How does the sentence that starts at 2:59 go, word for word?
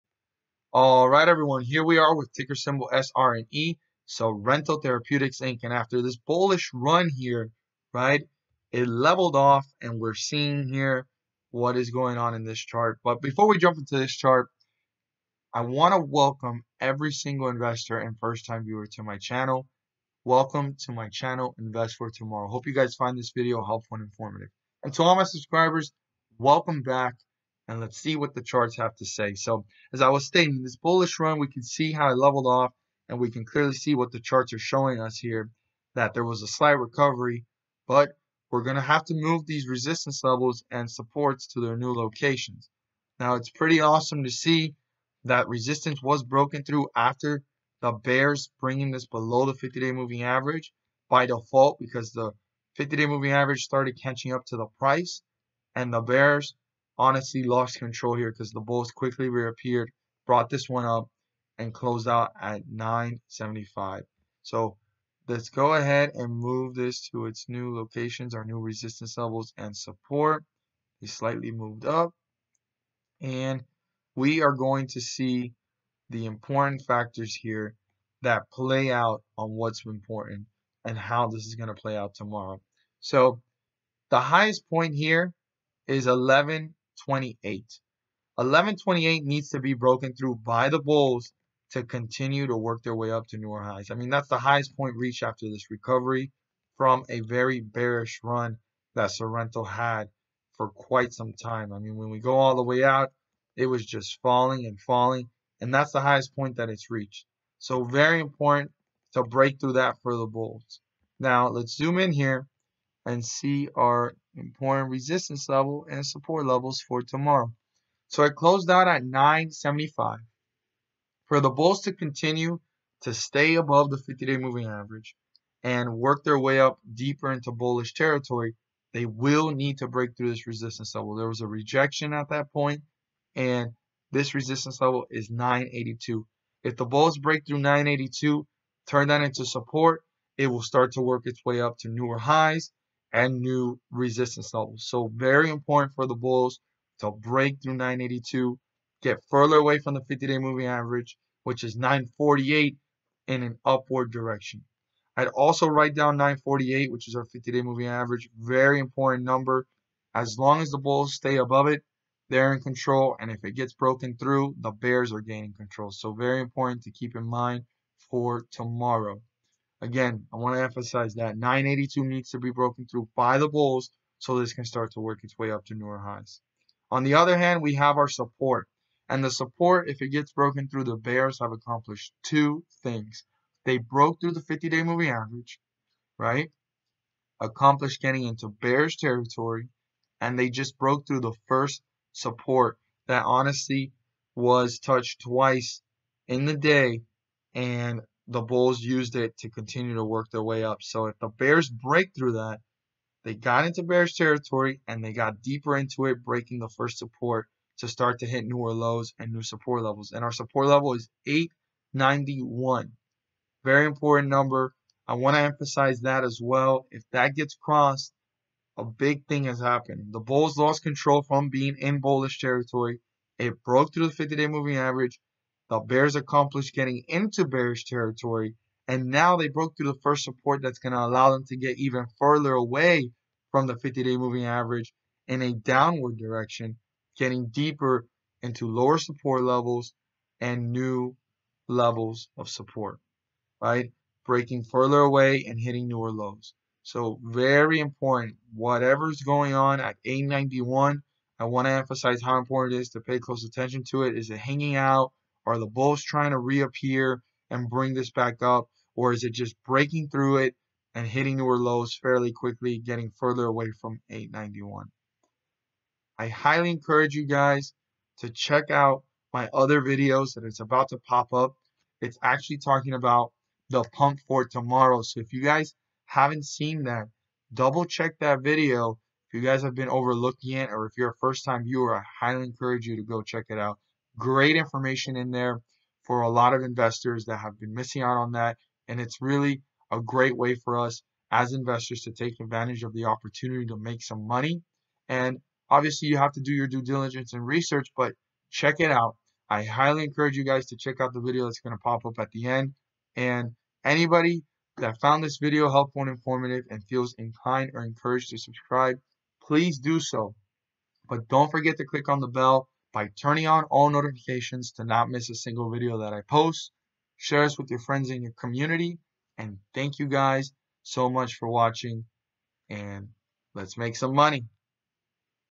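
And the support, if it gets broken through, the Bears have accomplished two things.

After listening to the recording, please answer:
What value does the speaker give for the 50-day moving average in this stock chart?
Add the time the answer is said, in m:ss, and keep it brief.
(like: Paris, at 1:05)
9.48, at 2:31.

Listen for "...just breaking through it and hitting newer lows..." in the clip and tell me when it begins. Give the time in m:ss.
4:19.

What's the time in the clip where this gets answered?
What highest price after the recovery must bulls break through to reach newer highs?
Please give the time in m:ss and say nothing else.
1:26.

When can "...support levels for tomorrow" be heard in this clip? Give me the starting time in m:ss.
1:56.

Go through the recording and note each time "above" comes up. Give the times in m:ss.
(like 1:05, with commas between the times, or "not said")
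2:03, 2:41.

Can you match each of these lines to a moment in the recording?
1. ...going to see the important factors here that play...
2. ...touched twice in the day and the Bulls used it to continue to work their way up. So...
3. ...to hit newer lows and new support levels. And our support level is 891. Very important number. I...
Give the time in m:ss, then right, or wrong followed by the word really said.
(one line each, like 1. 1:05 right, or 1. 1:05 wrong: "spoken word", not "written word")
1. 1:14 right
2. 3:14 right
3. 3:28 right.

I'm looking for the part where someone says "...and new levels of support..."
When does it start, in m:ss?
4:00.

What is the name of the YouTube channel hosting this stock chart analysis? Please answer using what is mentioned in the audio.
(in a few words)
Invest for Tomorrow.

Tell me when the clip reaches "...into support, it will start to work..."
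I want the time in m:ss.
2:19.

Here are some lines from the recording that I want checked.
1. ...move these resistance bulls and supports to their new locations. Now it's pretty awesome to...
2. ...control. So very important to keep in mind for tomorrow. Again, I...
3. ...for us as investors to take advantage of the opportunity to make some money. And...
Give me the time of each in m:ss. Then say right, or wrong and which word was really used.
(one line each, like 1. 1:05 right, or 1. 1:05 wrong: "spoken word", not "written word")
1. 0:39 wrong: "levels", not "bulls"
2. 2:45 right
3. 4:50 right.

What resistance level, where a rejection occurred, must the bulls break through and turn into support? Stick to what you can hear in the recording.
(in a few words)
9.82.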